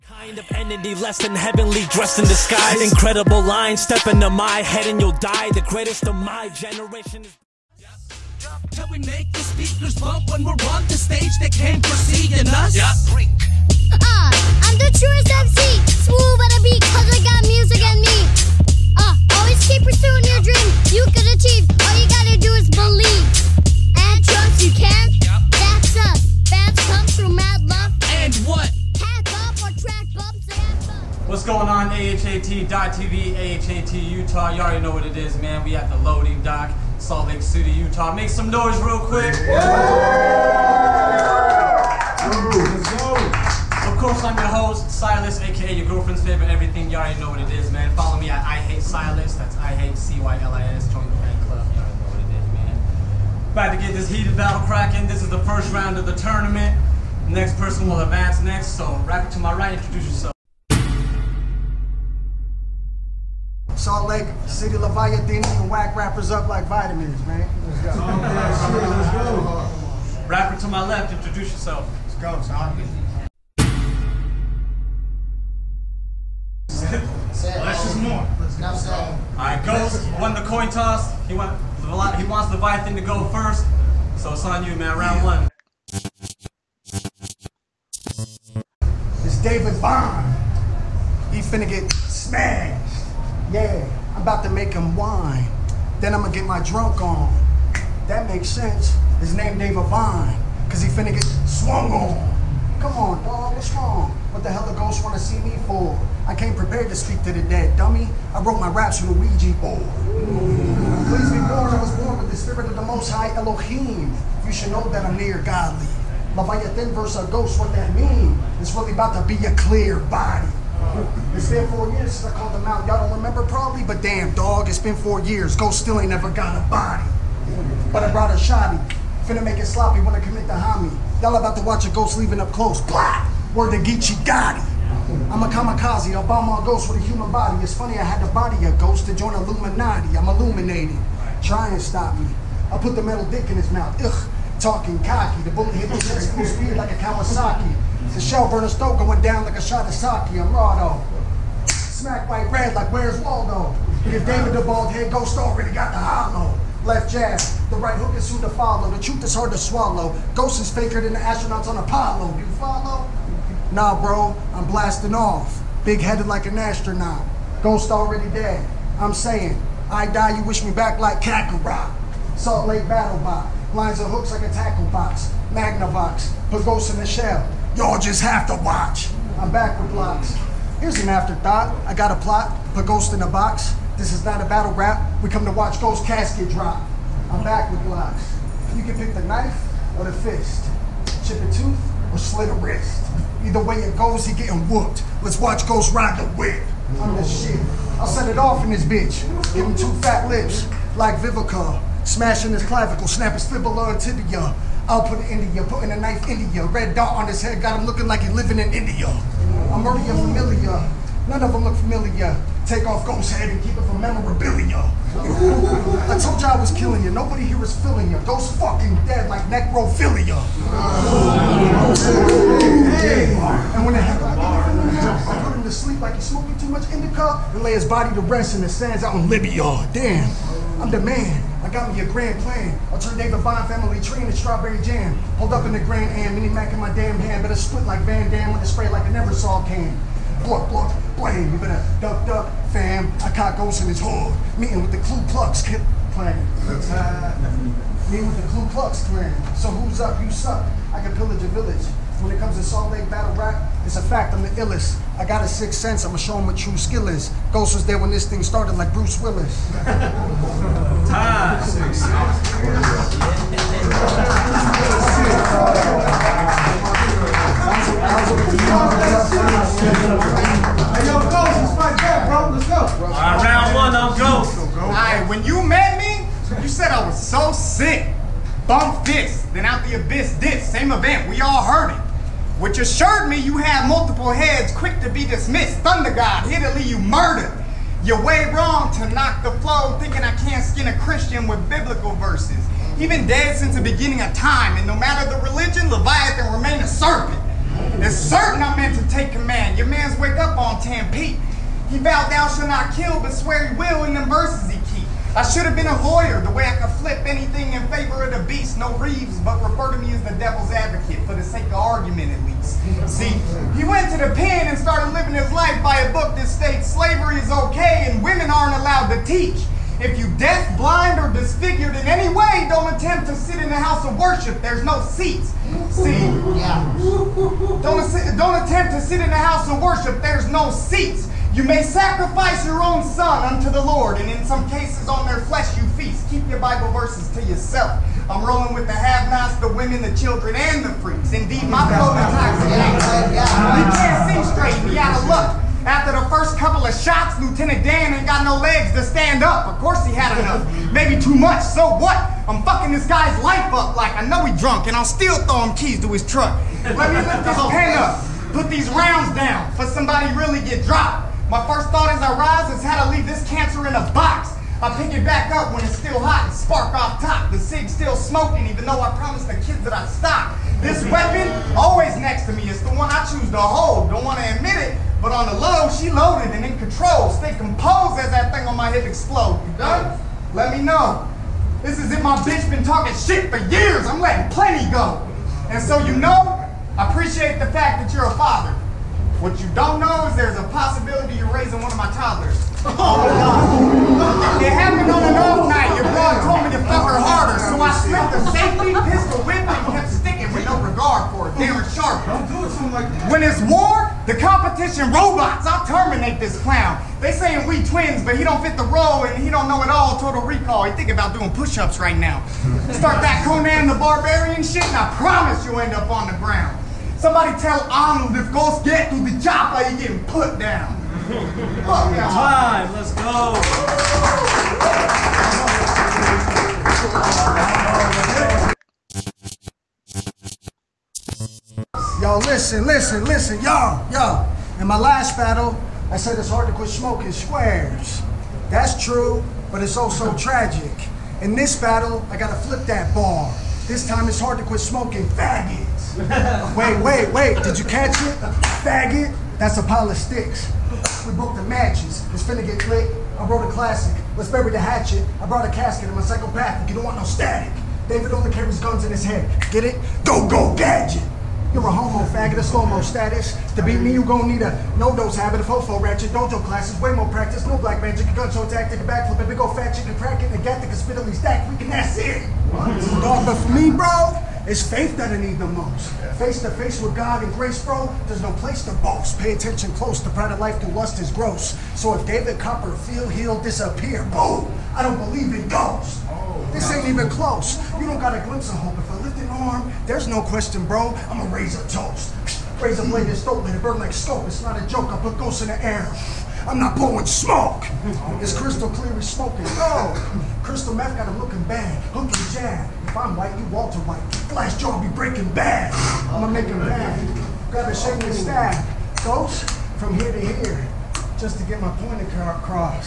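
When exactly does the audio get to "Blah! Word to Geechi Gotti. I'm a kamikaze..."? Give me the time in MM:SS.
02:12.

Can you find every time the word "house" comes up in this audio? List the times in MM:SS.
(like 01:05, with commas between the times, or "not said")
05:23, 05:29.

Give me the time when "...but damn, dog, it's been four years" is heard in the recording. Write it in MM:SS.
02:03.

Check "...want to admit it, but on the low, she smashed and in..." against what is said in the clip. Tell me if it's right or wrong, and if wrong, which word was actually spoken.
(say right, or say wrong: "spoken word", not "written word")
wrong: "loaded", not "smashed".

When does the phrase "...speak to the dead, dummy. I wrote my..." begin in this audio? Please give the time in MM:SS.
01:46.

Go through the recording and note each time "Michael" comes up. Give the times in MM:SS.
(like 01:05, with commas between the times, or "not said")
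not said.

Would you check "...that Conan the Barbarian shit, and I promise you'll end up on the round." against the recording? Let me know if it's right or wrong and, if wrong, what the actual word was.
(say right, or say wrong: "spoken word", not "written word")
wrong: "ground", not "round".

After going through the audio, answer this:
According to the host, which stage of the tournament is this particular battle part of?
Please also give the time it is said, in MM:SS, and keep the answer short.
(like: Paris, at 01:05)
First round, at 00:55.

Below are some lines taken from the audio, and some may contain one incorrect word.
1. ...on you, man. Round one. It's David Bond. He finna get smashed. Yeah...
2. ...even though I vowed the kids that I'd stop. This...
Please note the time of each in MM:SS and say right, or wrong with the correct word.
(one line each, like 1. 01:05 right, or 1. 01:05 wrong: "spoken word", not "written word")
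1. 01:24 right
2. 06:08 wrong: "promised", not "vowed".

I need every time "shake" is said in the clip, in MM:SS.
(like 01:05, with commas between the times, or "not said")
08:27.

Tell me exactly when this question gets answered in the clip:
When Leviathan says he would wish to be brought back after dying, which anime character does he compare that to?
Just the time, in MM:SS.
02:51.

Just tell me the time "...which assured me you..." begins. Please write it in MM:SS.
04:42.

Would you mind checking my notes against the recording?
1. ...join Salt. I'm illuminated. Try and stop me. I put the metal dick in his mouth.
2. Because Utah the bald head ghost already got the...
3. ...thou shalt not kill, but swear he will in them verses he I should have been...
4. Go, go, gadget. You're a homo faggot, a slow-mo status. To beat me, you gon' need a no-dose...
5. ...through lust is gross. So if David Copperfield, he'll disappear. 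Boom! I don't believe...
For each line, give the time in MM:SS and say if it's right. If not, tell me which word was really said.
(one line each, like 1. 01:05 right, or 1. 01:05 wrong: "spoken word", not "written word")
1. 02:19 wrong: "Illuminati", not "Salt"
2. 02:34 wrong: "David", not "Utah"
3. 05:02 right
4. 07:40 right
5. 08:00 right.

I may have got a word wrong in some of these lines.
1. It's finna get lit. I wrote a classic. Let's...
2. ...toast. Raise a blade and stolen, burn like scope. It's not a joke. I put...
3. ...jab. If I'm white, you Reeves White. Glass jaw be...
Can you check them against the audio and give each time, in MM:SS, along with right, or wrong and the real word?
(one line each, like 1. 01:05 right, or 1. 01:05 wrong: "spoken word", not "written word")
1. 07:32 right
2. 08:11 right
3. 08:22 wrong: "Walter", not "Reeves".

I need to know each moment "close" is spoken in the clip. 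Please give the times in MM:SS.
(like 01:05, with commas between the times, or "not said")
02:12, 07:59, 08:07.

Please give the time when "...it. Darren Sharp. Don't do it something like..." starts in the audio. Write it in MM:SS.
06:41.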